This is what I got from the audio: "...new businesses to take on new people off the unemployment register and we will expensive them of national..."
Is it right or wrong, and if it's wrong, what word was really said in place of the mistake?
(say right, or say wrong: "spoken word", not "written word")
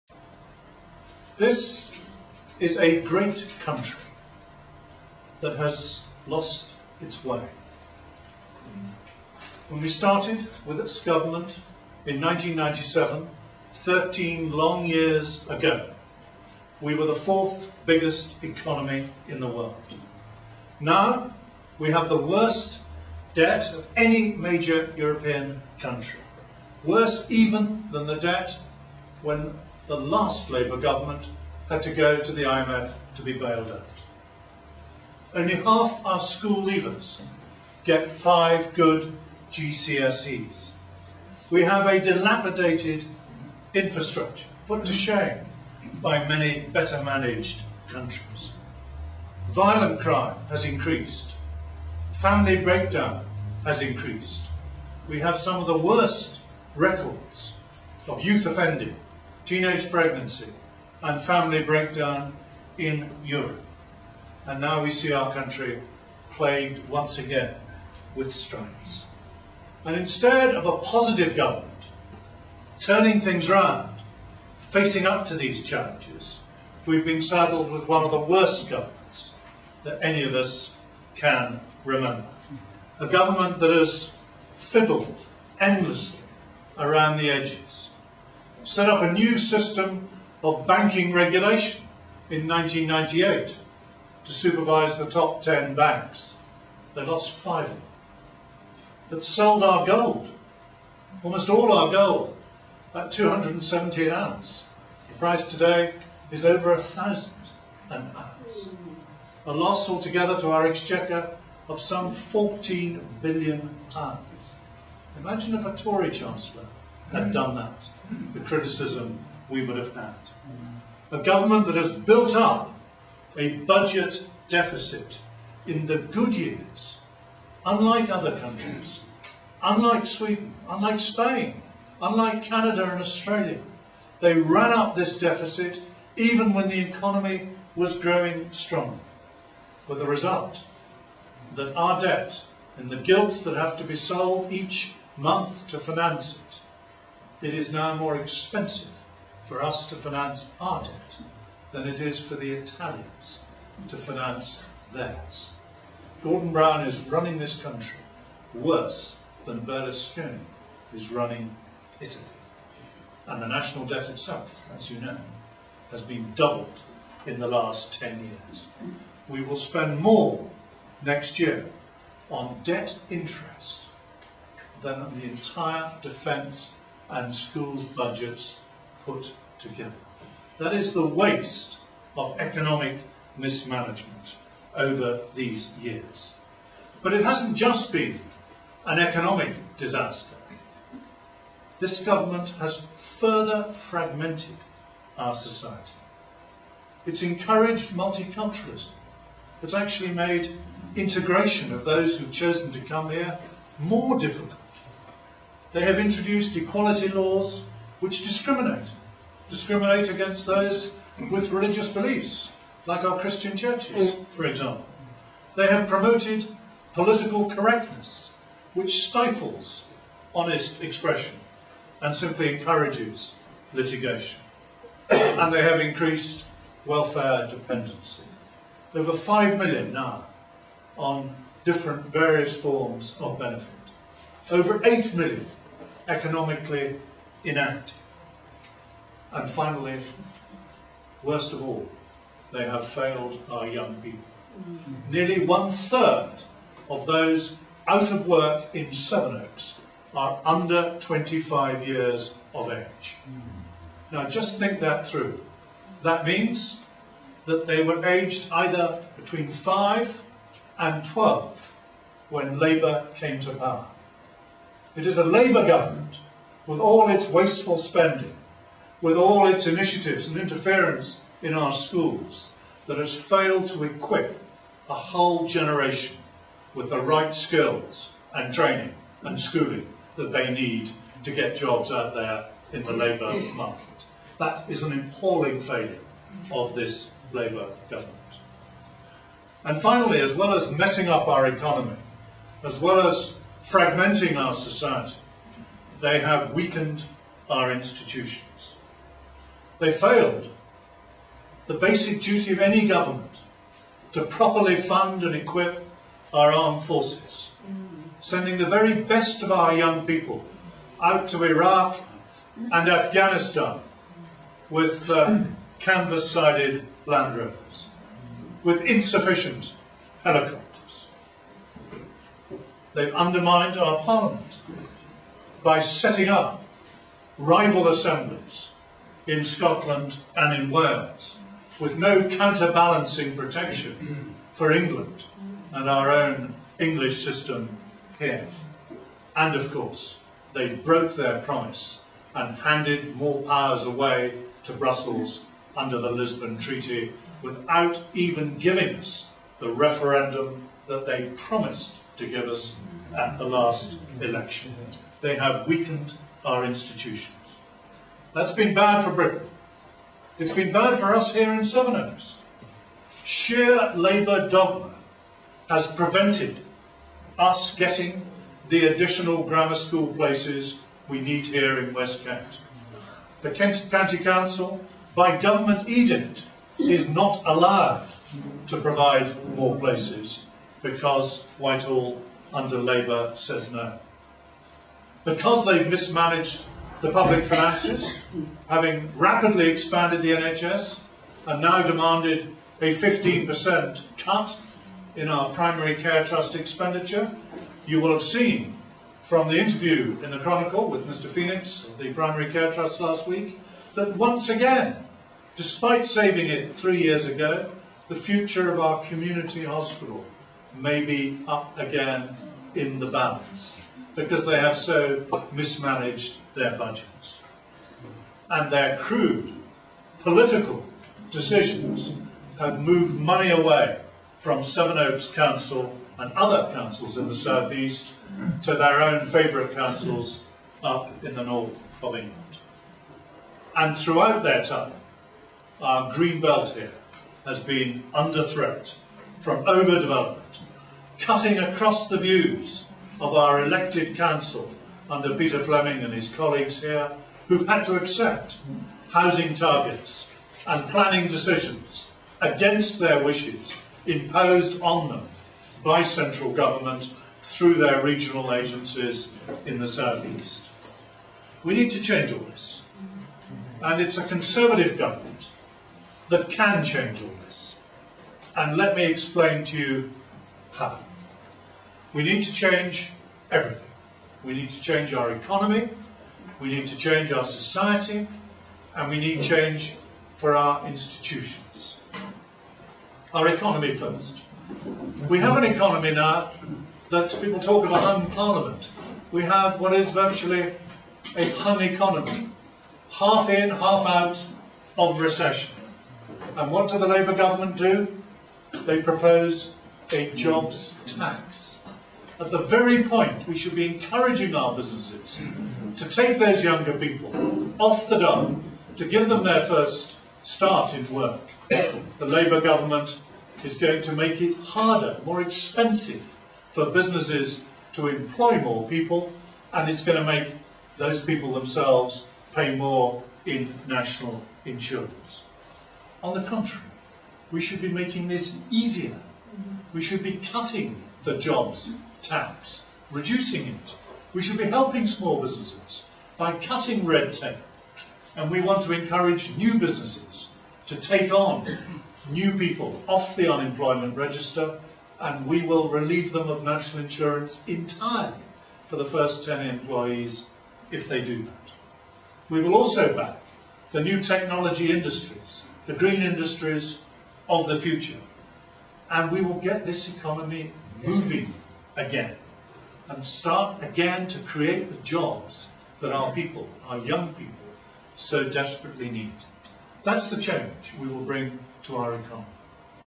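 wrong: "relieve", not "expensive".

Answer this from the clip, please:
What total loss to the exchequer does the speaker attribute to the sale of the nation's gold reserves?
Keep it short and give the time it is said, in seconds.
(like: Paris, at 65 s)
14 billion pounds, at 112 s.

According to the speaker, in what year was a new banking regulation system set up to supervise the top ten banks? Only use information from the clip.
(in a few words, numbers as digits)
1998.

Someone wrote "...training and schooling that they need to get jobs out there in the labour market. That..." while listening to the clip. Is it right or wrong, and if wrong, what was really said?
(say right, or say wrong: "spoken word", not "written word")
right.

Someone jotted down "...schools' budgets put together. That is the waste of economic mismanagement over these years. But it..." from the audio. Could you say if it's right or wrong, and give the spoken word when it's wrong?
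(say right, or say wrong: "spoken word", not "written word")
right.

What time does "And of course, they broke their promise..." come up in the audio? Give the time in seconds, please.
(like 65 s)
339 s.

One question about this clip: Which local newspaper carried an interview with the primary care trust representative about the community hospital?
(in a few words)
the Chronicle.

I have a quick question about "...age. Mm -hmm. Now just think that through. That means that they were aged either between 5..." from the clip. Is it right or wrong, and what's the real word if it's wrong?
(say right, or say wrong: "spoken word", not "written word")
right.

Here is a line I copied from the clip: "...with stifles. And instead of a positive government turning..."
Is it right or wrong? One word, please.
wrong.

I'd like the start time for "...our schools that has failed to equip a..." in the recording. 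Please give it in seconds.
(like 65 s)
271 s.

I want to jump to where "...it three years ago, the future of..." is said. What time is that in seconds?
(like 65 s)
406 s.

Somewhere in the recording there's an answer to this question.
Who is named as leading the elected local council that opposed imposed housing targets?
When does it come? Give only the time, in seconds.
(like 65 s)
445 s.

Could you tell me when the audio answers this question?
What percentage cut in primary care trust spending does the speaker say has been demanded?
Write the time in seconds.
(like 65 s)
392 s.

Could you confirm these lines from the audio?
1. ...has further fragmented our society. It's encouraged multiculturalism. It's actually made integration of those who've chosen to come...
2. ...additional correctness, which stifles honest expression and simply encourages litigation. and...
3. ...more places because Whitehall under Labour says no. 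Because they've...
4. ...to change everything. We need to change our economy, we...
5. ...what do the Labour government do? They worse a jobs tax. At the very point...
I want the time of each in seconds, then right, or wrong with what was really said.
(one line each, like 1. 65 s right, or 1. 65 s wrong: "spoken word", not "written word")
1. 192 s right
2. 216 s wrong: "political", not "additional"
3. 379 s right
4. 472 s right
5. 496 s wrong: "propose", not "worse".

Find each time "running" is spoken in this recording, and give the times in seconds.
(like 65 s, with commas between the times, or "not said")
157 s, 161 s.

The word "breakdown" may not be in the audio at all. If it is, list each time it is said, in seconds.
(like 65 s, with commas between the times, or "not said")
52 s, 61 s.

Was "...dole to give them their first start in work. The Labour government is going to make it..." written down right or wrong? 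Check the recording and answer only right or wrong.
right.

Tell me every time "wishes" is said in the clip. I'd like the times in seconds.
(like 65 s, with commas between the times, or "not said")
453 s.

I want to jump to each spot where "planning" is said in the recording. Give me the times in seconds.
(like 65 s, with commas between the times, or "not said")
450 s.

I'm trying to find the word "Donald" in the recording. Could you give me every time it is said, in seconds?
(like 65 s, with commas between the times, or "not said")
not said.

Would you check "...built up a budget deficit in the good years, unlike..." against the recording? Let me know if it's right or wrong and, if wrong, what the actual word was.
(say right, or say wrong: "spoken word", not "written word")
right.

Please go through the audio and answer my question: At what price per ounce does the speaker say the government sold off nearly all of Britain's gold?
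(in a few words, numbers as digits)
217.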